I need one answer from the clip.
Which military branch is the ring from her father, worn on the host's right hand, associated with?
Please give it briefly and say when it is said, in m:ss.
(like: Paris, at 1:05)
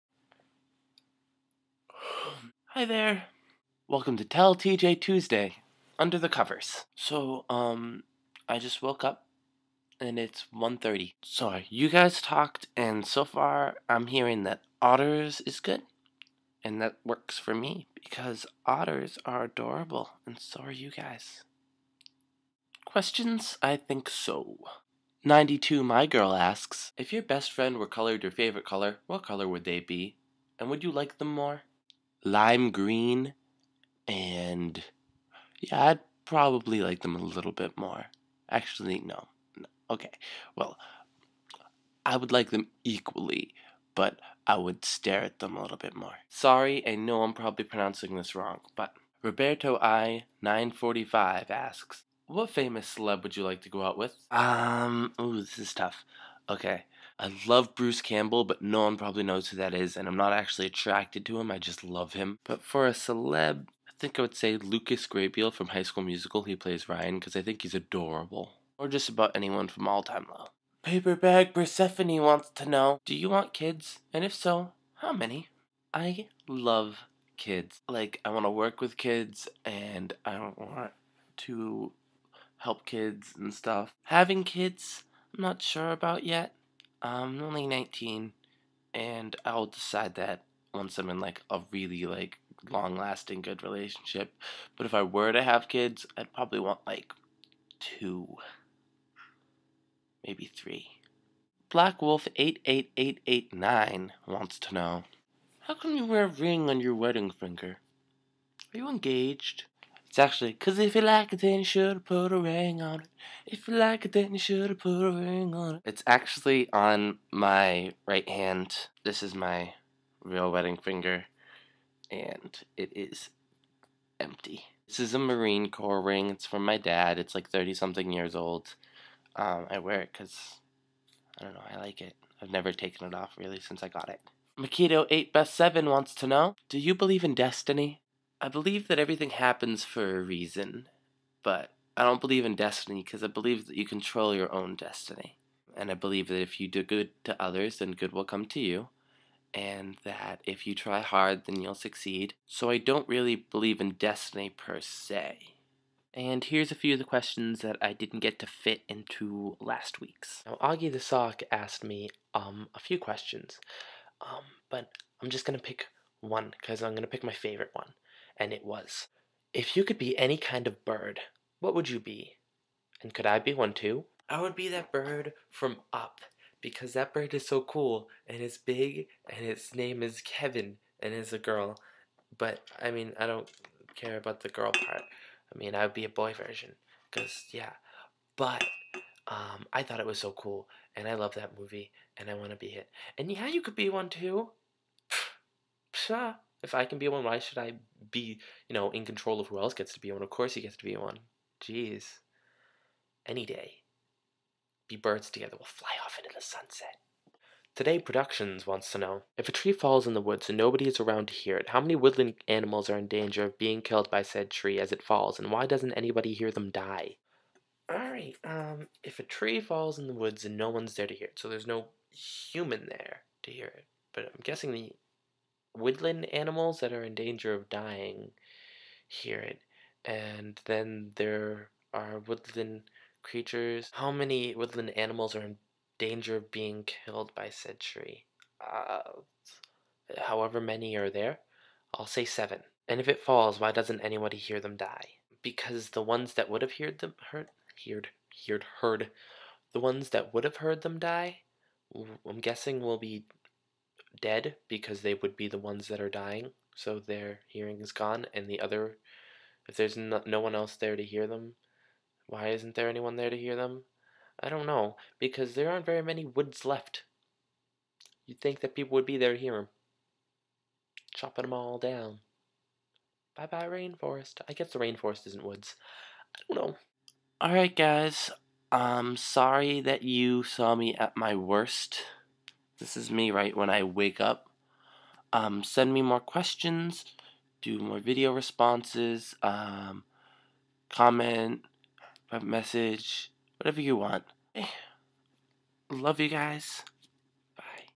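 Marine Corps, at 2:05.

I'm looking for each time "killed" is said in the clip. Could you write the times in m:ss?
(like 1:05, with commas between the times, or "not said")
3:33, 3:56.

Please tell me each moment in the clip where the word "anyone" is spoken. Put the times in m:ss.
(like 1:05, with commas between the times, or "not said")
1:09, 4:22.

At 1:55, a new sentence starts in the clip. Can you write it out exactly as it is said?
It's actually on my right hand.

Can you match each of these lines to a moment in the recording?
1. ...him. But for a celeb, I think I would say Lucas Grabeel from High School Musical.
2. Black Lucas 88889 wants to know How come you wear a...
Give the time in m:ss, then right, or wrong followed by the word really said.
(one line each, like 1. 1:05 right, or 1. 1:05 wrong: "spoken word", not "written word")
1. 1:02 right
2. 1:41 wrong: "Wolf", not "Lucas".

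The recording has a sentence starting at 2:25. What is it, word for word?
And I believe that if you do good to others, then good will come to you.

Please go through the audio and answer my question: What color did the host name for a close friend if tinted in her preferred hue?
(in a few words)
lime green.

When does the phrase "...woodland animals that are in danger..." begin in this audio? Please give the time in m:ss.
3:45.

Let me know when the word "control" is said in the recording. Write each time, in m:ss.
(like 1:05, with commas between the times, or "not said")
2:23, 3:19.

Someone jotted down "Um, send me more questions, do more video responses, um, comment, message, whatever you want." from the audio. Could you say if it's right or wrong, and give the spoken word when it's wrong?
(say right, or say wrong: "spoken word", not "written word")
right.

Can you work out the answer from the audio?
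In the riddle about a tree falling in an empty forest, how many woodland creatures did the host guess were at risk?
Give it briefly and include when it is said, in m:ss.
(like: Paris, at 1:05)
7, at 4:02.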